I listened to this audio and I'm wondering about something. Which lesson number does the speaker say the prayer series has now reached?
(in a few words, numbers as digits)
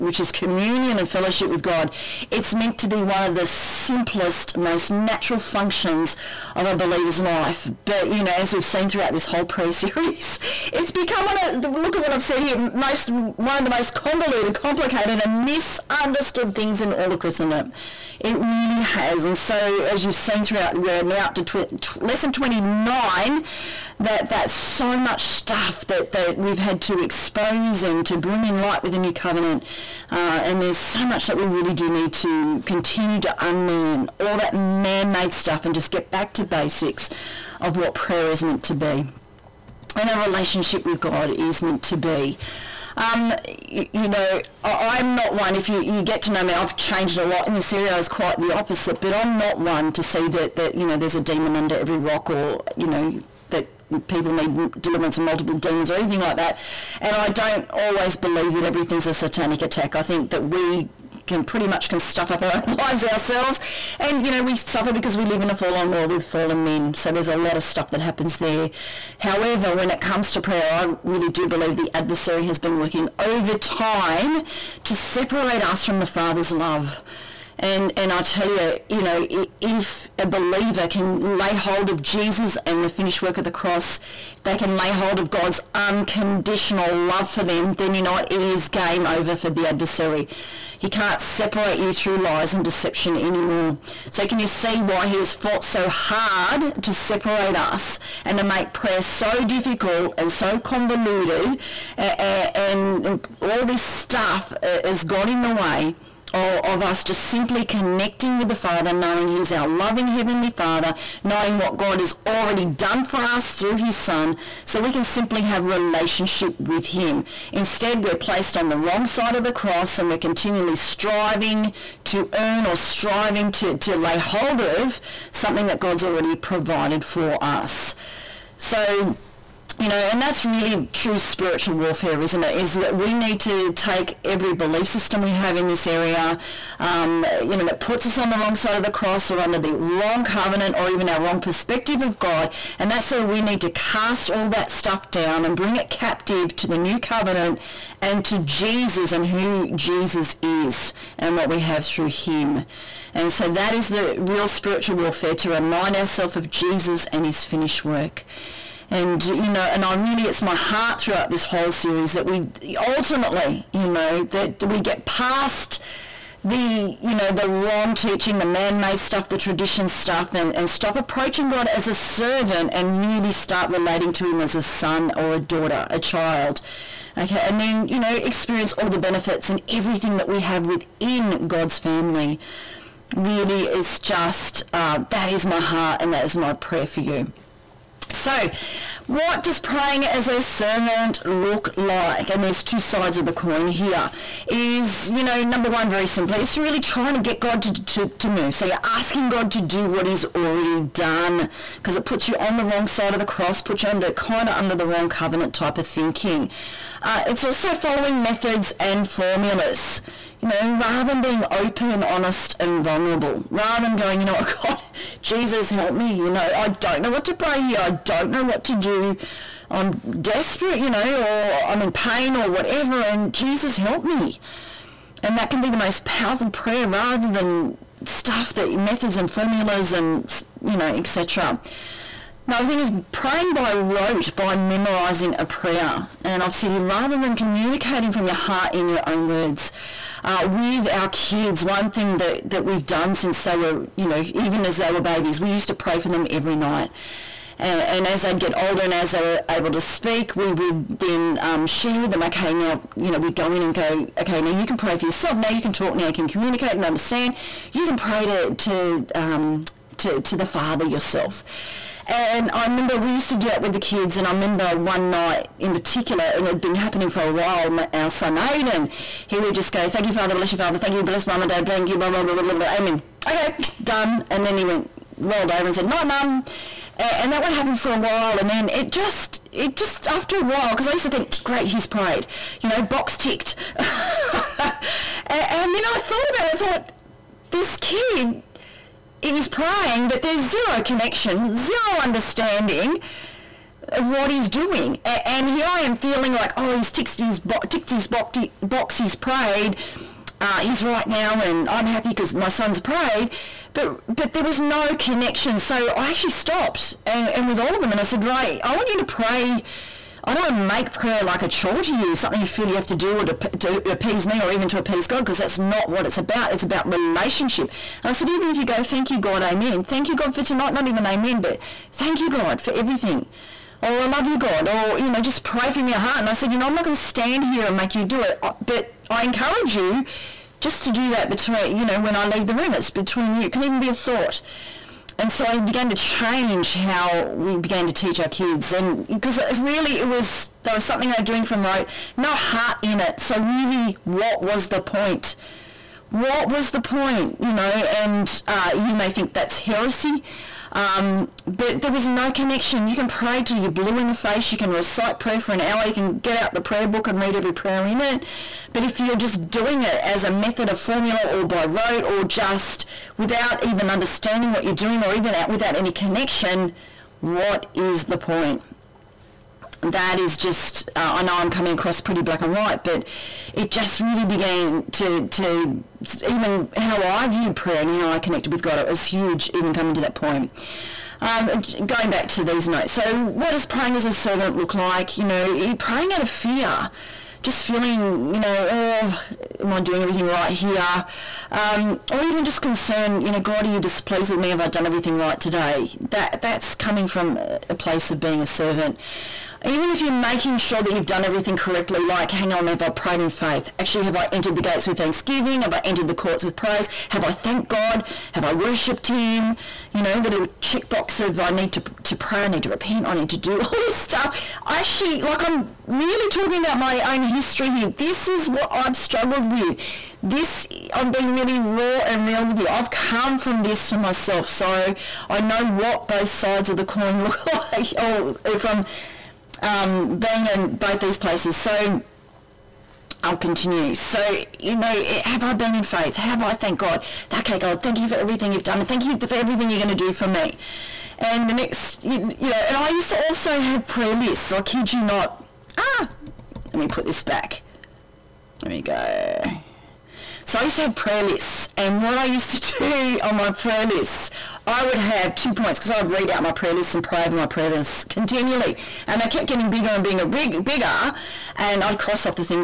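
29.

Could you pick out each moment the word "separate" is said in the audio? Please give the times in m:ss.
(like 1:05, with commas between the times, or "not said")
1:14, 1:31, 1:36.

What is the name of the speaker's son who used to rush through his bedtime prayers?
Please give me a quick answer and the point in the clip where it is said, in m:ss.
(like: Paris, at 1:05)
Aiden, at 4:28.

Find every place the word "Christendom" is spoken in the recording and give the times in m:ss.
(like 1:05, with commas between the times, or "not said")
0:17.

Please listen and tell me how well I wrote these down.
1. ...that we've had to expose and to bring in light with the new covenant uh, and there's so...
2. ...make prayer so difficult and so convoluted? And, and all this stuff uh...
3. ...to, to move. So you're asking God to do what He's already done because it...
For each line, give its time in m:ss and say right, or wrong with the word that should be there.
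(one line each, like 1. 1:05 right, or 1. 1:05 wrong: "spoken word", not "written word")
1. 0:26 right
2. 1:38 right
3. 3:17 right.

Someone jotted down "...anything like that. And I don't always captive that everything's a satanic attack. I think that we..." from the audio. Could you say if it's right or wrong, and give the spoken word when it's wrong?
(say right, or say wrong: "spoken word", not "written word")
wrong: "believe", not "captive".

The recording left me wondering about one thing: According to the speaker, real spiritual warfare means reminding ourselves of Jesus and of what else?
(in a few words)
his finished work.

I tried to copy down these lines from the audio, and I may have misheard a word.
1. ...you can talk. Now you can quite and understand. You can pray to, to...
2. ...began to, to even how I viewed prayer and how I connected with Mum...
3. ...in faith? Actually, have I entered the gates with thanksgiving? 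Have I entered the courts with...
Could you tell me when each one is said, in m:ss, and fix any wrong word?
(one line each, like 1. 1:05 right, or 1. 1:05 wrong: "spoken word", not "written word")
1. 4:15 wrong: "communicate", not "quite"
2. 6:14 wrong: "God", not "Mum"
3. 6:43 right.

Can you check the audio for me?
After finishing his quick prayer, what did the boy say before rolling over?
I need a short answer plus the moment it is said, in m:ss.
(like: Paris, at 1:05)
Night, Mum, at 4:35.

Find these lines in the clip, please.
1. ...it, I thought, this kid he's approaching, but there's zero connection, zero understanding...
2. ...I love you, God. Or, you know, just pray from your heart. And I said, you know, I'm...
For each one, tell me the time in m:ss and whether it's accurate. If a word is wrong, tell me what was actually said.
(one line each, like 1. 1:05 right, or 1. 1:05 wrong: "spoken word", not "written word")
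1. 4:46 wrong: "praying", not "approaching"
2. 5:24 right.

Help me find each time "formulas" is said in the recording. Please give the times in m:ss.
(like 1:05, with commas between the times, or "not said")
3:29, 3:49, 6:00.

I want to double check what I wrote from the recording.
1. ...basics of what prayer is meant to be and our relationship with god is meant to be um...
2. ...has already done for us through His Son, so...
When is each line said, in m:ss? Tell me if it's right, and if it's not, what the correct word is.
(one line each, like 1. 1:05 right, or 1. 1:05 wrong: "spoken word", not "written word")
1. 0:36 right
2. 1:51 right.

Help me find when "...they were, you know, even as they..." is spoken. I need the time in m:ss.
4:03.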